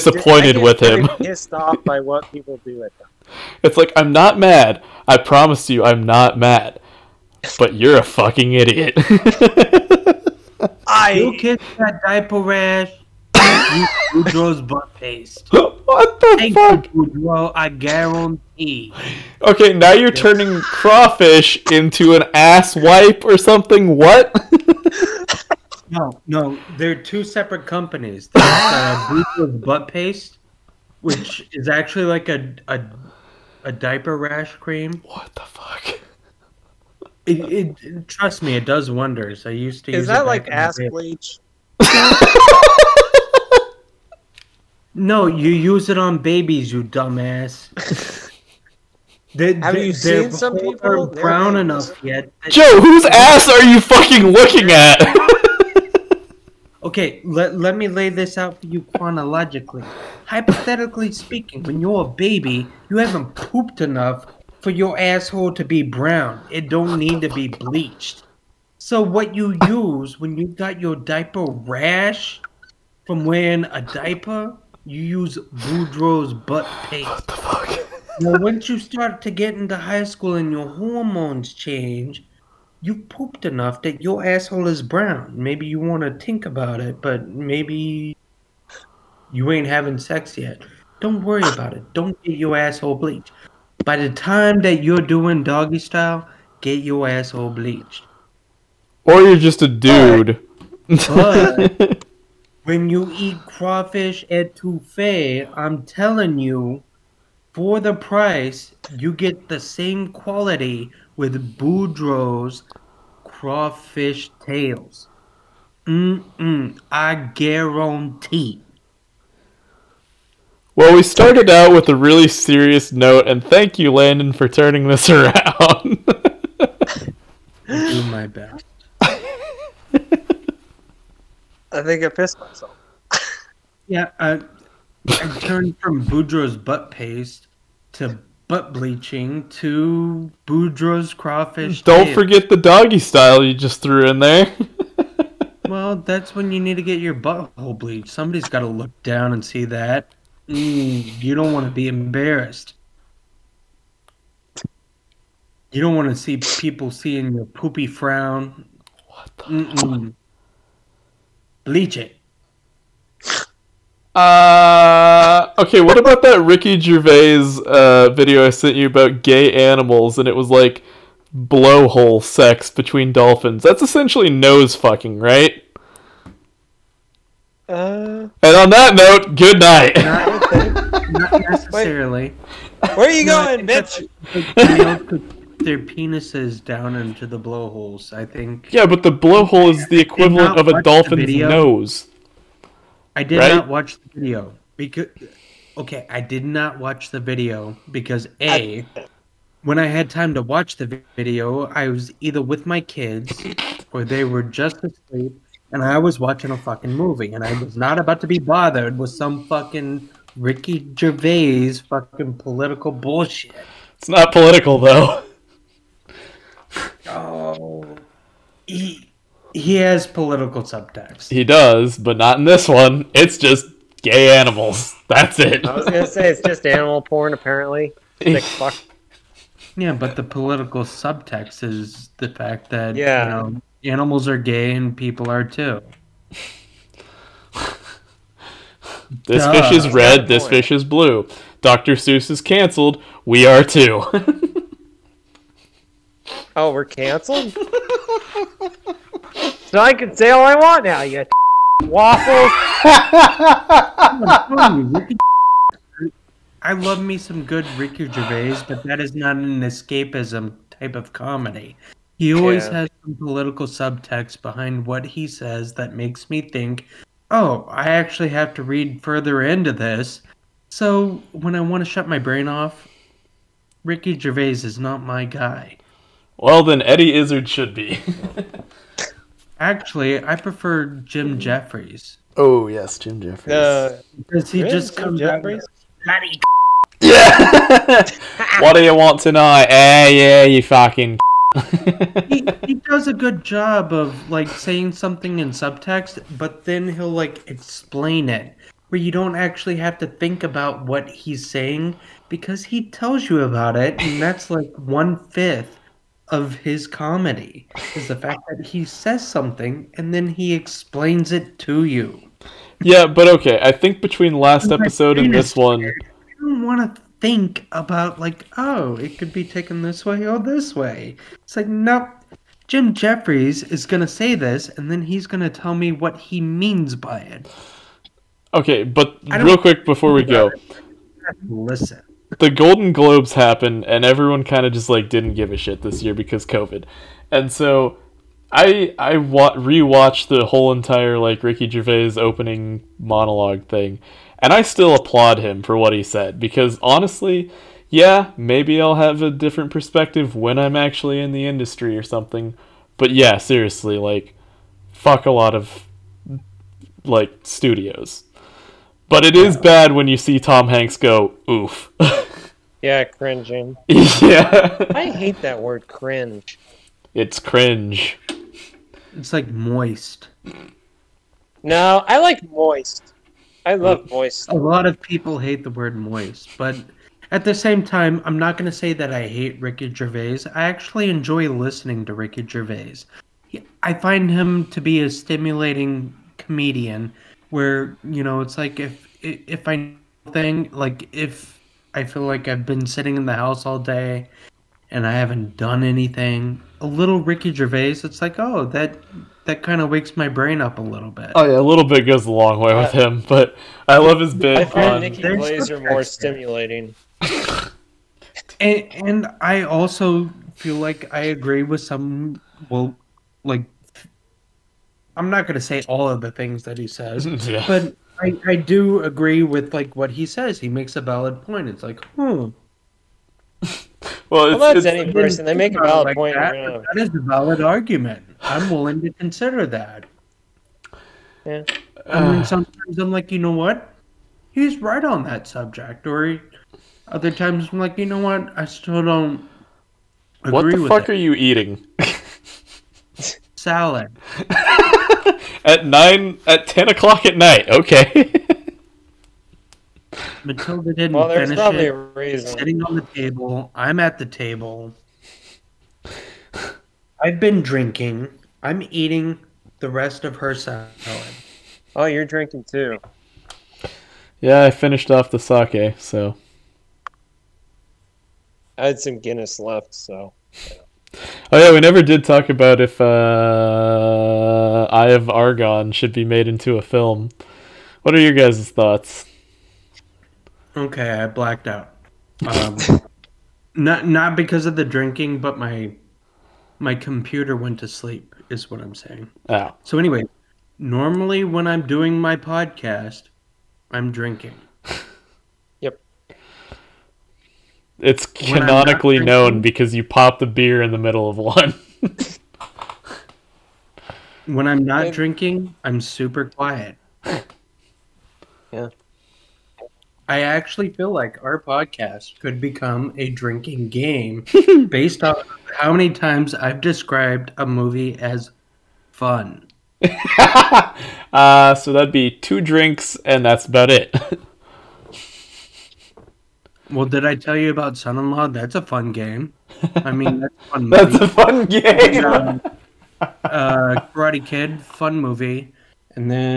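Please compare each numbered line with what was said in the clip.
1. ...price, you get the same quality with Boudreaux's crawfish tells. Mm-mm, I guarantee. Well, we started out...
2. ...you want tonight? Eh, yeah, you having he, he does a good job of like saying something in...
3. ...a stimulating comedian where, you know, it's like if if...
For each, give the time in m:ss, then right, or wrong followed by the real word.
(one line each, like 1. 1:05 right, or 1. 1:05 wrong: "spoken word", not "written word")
1. 1:47 wrong: "tails", not "tells"
2. 4:48 wrong: "fucking", not "having"
3. 6:25 right.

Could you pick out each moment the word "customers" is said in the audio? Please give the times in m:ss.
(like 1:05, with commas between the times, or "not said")
not said.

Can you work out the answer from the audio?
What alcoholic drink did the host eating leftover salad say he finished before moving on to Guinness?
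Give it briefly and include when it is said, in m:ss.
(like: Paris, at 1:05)
sake, at 7:45.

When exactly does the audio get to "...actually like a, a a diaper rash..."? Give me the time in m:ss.
0:31.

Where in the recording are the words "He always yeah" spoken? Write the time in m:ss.
4:22.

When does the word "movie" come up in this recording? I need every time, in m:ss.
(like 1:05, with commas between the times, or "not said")
3:26, 8:37, 8:55.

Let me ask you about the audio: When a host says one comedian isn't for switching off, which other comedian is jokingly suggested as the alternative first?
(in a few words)
Eddie Izzard.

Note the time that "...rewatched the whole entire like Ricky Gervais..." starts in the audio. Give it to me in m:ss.
5:39.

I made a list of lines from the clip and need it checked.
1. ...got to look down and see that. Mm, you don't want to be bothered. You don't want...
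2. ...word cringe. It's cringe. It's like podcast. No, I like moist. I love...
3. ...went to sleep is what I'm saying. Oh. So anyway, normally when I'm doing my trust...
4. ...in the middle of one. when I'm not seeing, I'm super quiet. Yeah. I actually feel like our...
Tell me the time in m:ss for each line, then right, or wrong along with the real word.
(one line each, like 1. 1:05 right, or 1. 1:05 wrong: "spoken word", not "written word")
1. 2:28 wrong: "embarrassed", not "bothered"
2. 6:05 wrong: "moist", not "podcast"
3. 8:07 wrong: "podcast", not "trust"
4. 8:20 wrong: "drinking", not "seeing".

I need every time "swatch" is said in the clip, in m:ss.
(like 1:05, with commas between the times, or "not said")
not said.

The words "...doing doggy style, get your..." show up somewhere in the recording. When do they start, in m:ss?
1:35.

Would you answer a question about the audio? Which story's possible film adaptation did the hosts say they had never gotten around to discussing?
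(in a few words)
Eye of Argon.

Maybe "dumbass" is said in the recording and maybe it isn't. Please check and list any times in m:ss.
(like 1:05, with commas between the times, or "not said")
0:46.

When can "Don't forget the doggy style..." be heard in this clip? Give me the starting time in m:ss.
2:21.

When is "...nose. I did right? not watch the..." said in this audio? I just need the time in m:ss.
3:11.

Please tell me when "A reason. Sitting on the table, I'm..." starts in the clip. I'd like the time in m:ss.
7:31.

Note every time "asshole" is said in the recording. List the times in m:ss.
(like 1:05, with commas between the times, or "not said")
1:04, 1:24, 1:32, 1:37.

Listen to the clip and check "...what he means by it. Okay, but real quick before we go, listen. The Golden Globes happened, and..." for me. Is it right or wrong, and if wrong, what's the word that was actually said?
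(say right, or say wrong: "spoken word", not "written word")
right.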